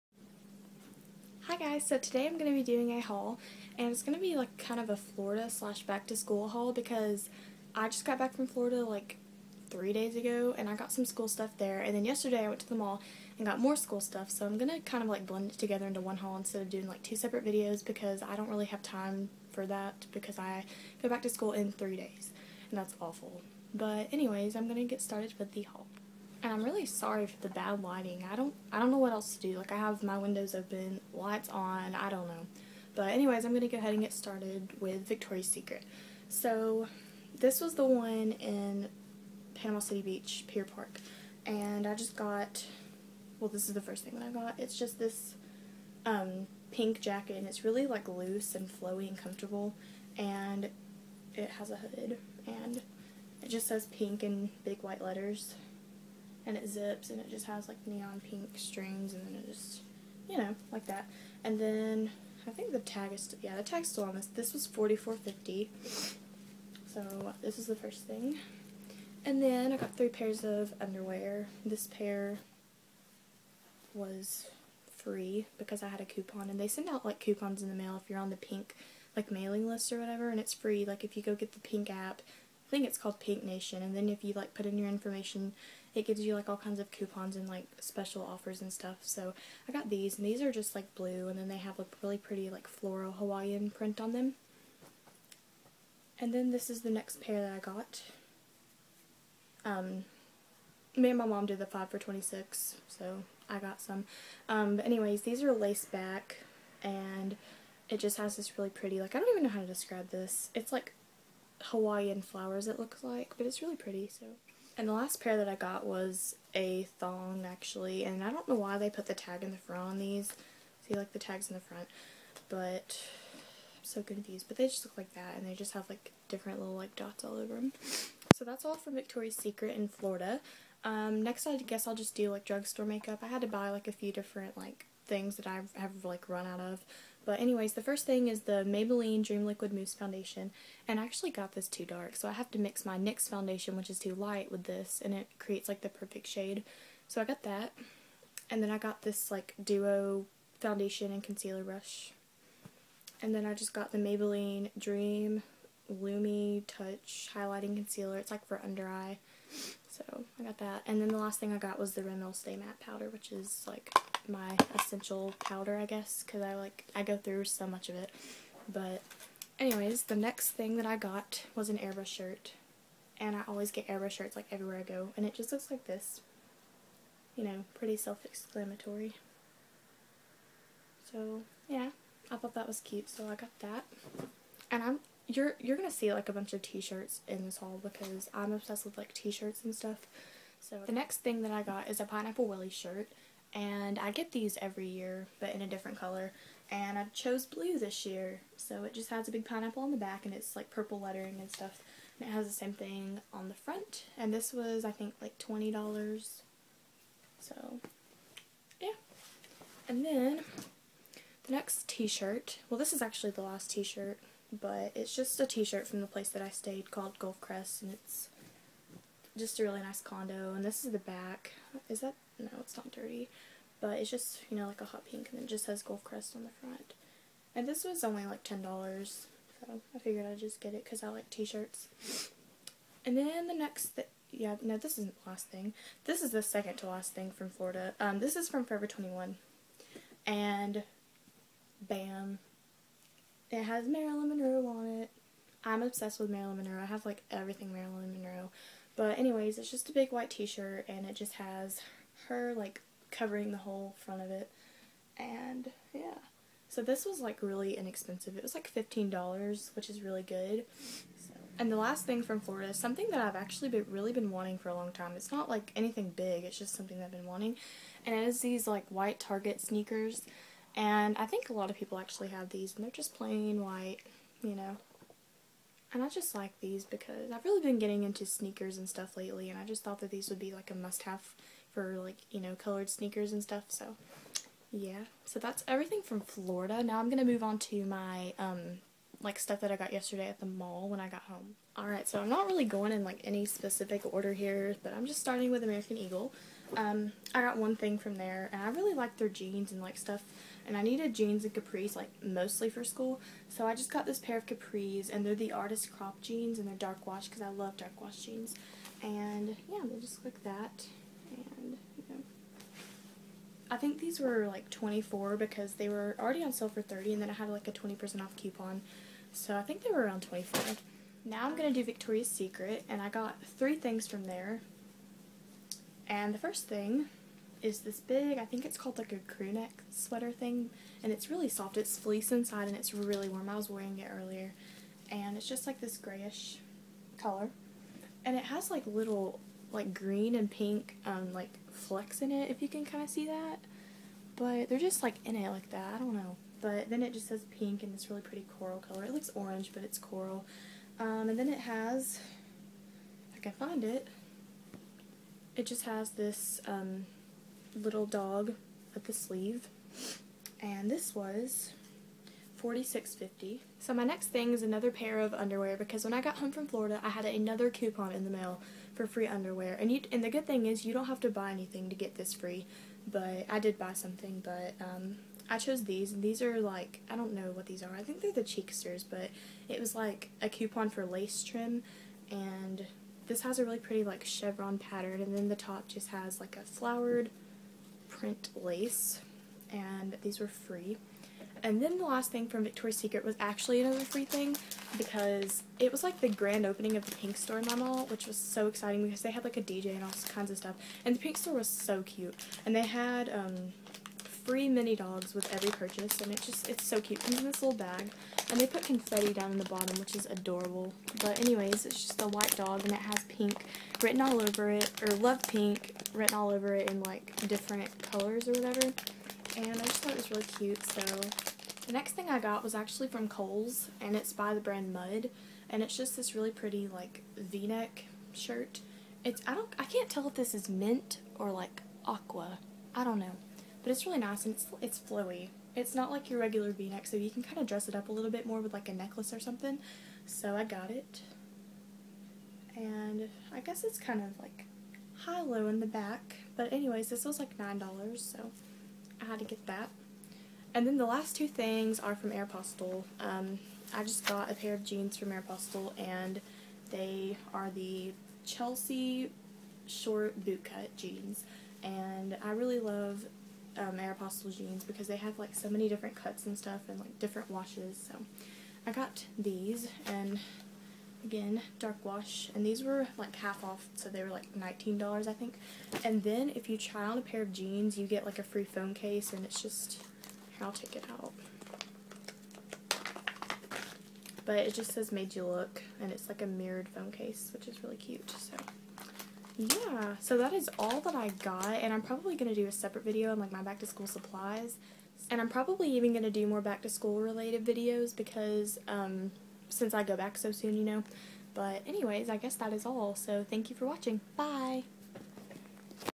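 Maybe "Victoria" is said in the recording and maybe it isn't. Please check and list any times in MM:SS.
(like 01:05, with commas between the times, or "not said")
00:35, 02:08, 05:21, 06:32.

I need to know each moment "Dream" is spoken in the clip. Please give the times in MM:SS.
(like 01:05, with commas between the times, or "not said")
02:19, 02:34.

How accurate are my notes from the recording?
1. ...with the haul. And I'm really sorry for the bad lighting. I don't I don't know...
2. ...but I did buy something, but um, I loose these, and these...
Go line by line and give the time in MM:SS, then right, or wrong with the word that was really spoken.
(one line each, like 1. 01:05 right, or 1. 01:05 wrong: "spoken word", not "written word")
1. 00:25 right
2. 06:13 wrong: "chose", not "loose".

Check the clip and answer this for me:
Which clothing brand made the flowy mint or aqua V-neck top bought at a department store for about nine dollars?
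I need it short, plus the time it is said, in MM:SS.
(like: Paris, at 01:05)
Mudd, at 07:04.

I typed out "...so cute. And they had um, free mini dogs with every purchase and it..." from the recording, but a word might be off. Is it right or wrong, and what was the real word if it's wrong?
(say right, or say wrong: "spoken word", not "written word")
right.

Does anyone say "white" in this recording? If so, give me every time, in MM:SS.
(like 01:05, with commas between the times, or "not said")
00:54, 04:10, 04:28, 04:33, 06:52.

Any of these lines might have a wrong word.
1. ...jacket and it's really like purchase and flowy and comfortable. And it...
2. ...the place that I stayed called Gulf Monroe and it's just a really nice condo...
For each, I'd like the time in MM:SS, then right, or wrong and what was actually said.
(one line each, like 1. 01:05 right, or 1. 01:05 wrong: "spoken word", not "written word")
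1. 00:47 wrong: "loose", not "purchase"
2. 03:36 wrong: "Crest", not "Monroe".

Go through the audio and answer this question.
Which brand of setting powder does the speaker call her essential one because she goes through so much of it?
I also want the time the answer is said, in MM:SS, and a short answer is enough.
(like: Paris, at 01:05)
Rimmel, at 02:42.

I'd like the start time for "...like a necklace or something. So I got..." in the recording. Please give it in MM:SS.
07:18.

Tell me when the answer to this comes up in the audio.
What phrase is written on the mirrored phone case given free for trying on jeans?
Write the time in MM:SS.
08:05.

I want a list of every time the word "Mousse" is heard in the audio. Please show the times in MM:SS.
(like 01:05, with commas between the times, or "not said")
02:19.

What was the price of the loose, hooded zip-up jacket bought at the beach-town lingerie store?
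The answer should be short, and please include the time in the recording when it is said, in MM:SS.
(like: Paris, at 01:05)
$44.50, at 01:04.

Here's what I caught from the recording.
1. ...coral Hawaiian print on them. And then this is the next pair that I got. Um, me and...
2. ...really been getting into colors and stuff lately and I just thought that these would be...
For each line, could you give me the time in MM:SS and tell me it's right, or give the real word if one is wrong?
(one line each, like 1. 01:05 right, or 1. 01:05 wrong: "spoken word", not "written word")
1. 01:32 wrong: "floral", not "coral"
2. 04:37 wrong: "sneakers", not "colors".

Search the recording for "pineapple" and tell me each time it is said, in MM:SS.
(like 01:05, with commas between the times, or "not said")
03:12, 03:19.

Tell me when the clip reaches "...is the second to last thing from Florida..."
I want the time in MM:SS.
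03:56.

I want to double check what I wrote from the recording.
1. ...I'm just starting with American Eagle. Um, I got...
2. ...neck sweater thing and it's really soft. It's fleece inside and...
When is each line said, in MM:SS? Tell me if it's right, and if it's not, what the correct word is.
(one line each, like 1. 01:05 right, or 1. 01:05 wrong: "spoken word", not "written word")
1. 04:54 right
2. 05:29 right.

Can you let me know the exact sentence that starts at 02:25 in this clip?
And it creates like the perfect shade.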